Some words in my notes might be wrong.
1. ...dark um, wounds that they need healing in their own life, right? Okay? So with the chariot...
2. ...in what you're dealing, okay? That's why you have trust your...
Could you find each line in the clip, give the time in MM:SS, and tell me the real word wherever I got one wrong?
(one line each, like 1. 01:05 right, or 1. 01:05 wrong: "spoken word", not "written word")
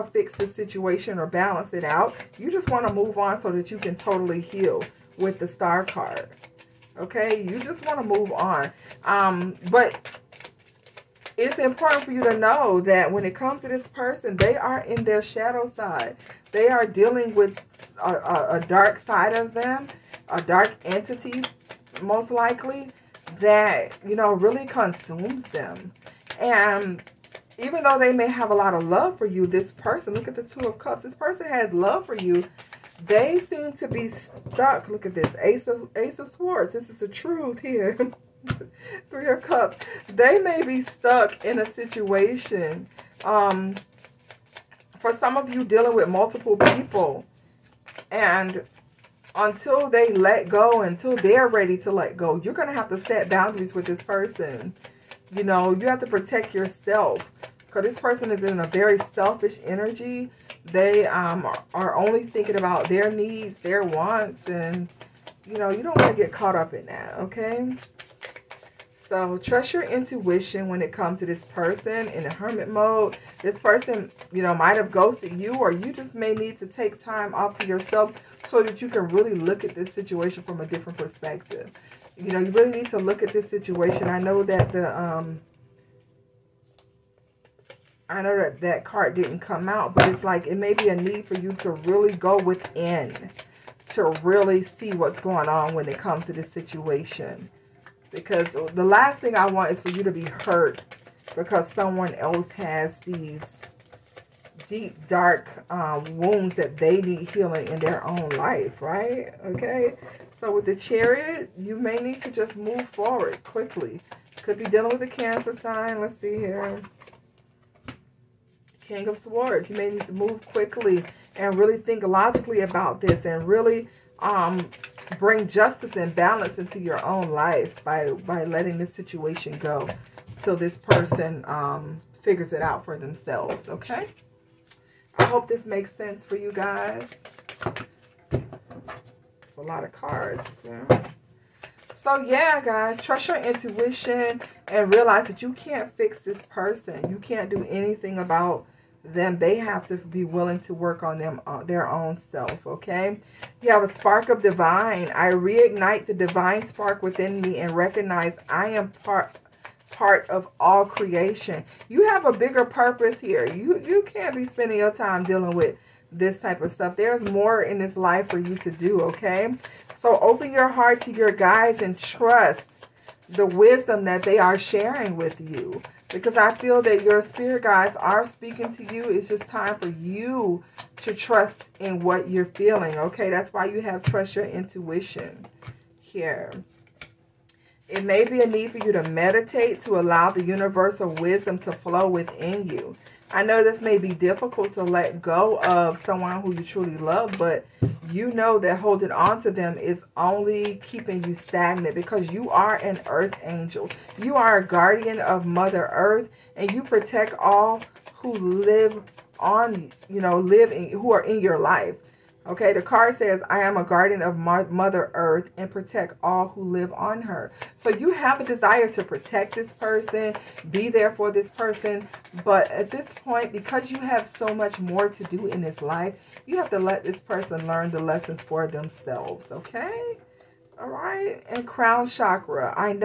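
1. 01:45 right
2. 03:01 wrong: "feeling", not "dealing".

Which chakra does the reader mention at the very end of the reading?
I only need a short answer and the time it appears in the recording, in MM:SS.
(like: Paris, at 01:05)
Crown chakra, at 03:51.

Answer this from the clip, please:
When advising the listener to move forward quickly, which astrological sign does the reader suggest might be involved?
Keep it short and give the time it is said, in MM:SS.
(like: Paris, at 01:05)
Cancer, at 01:55.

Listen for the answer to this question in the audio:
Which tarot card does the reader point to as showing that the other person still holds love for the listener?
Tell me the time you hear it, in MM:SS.
00:30.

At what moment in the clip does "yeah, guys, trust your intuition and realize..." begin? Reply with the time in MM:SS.
02:22.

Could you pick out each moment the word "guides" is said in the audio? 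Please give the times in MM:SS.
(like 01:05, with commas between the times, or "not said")
02:51, 02:57.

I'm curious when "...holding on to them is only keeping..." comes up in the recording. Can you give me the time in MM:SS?
03:18.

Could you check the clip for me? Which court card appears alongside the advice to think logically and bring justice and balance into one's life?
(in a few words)
King of Swords.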